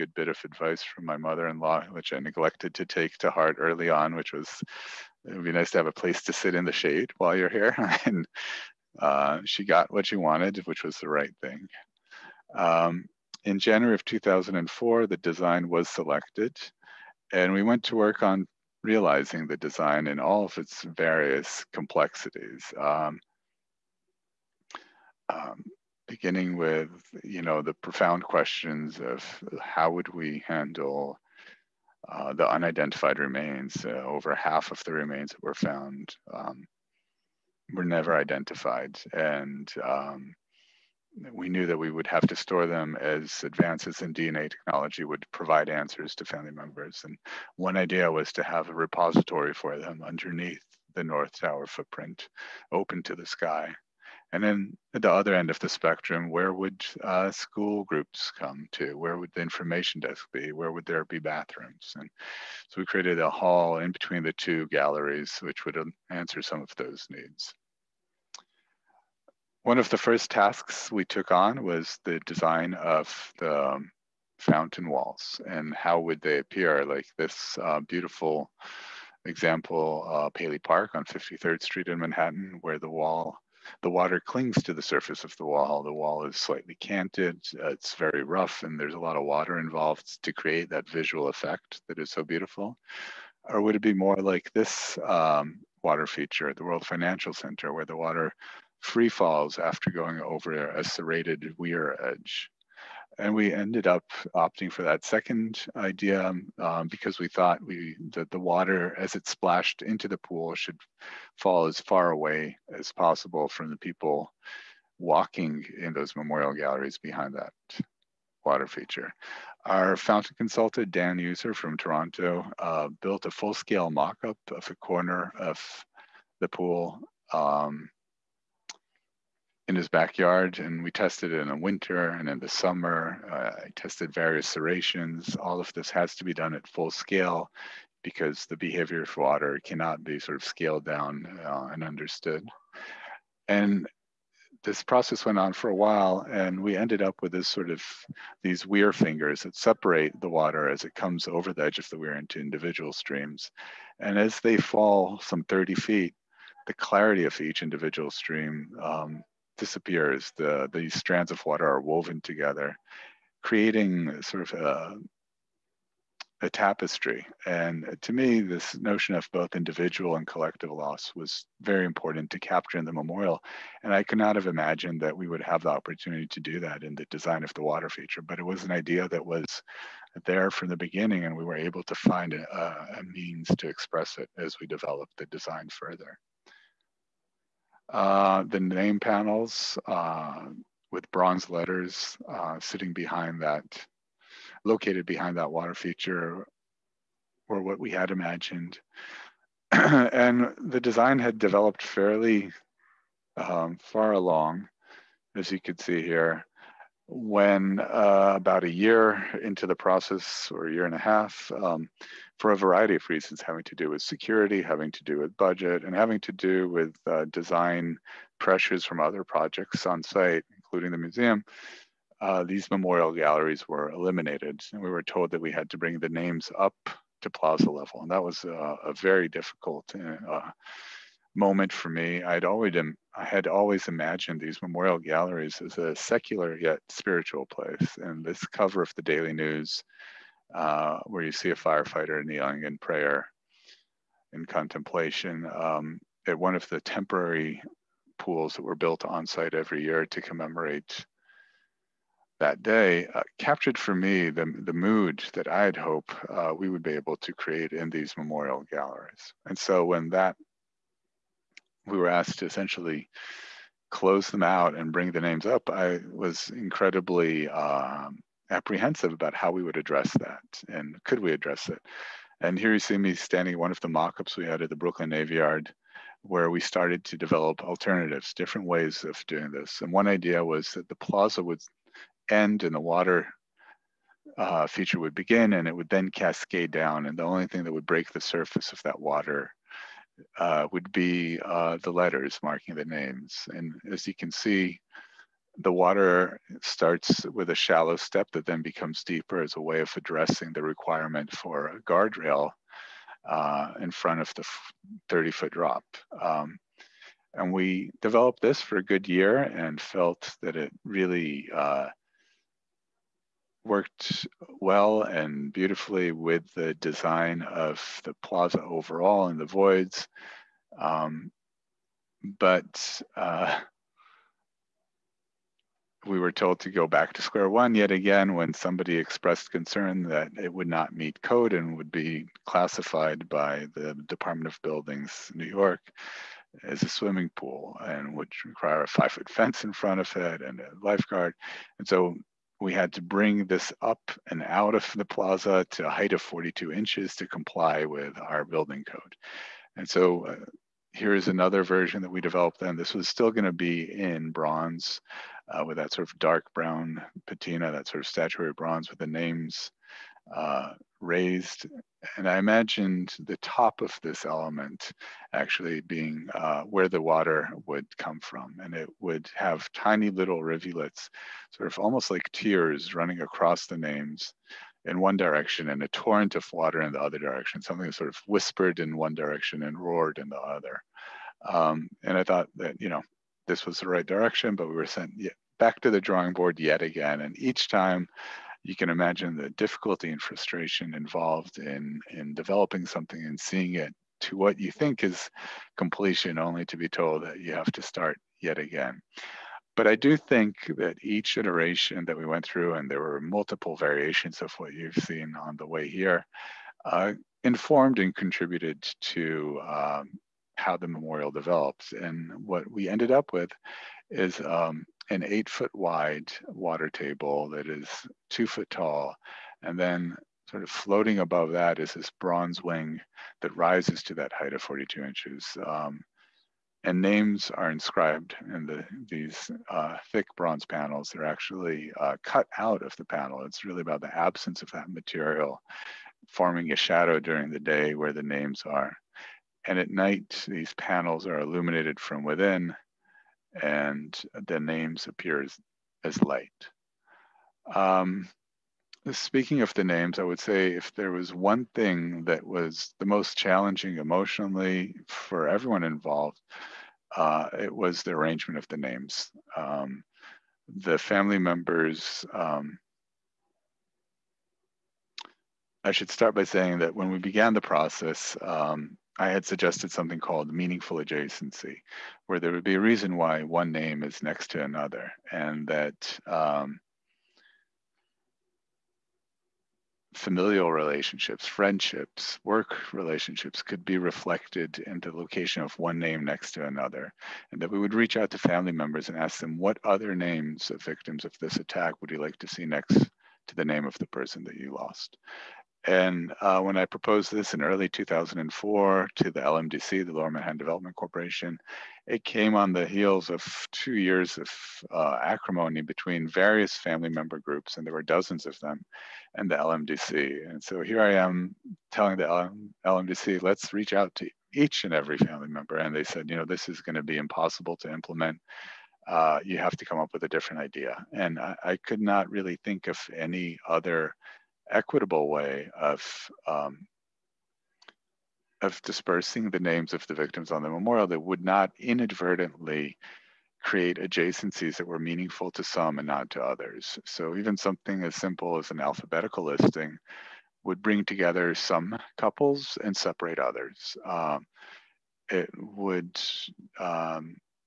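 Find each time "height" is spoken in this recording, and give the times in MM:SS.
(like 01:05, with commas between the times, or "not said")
05:45, 07:04.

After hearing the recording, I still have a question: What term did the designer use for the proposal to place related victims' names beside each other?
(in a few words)
meaningful adjacency.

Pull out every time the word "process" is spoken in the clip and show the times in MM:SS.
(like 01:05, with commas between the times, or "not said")
02:24, 03:29, 07:47.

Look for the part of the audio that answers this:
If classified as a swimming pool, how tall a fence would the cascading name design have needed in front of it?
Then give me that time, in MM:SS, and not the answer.
05:38.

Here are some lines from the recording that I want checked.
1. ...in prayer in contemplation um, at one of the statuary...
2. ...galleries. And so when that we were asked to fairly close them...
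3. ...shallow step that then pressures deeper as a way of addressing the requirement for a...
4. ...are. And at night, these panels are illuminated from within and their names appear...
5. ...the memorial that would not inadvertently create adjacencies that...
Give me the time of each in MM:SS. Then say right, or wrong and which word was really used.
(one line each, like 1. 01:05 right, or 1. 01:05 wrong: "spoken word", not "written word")
1. 04:02 wrong: "temporary", not "statuary"
2. 04:18 wrong: "essentially", not "fairly"
3. 04:57 wrong: "becomes", not "pressures"
4. 07:18 right
5. 08:50 right.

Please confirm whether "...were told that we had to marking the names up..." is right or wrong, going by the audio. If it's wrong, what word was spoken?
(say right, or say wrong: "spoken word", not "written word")
wrong: "bring", not "marking".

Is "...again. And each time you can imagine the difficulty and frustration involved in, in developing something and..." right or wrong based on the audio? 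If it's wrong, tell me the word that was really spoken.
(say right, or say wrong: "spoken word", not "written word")
right.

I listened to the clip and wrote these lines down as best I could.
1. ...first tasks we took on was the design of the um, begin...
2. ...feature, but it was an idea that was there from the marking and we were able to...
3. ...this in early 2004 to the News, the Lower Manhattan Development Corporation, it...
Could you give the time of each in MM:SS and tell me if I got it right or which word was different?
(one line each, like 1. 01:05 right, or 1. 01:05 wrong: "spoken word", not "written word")
1. 01:09 wrong: "fountain", not "begin"
2. 02:57 wrong: "beginning", not "marking"
3. 08:17 wrong: "LMDC", not "News".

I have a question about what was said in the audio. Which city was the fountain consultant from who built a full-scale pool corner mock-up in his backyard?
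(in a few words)
Toronto.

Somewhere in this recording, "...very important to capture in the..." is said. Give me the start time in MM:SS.
02:51.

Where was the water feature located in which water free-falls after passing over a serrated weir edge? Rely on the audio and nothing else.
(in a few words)
World Financial Center.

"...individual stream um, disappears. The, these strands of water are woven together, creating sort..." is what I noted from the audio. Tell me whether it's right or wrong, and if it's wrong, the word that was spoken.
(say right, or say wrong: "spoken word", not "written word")
right.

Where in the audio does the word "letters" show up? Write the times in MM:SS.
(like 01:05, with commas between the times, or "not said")
03:11, 04:51.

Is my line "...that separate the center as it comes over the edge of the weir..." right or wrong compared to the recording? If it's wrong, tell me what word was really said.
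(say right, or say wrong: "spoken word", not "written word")
wrong: "water", not "center".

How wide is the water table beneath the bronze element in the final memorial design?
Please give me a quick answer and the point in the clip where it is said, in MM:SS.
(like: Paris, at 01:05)
8 feet, at 06:55.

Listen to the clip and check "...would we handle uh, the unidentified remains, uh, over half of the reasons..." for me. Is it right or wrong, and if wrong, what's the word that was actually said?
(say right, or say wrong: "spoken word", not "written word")
wrong: "remains", not "reasons".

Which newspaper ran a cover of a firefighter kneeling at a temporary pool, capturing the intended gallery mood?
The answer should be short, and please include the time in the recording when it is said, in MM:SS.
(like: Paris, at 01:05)
Daily News, at 03:59.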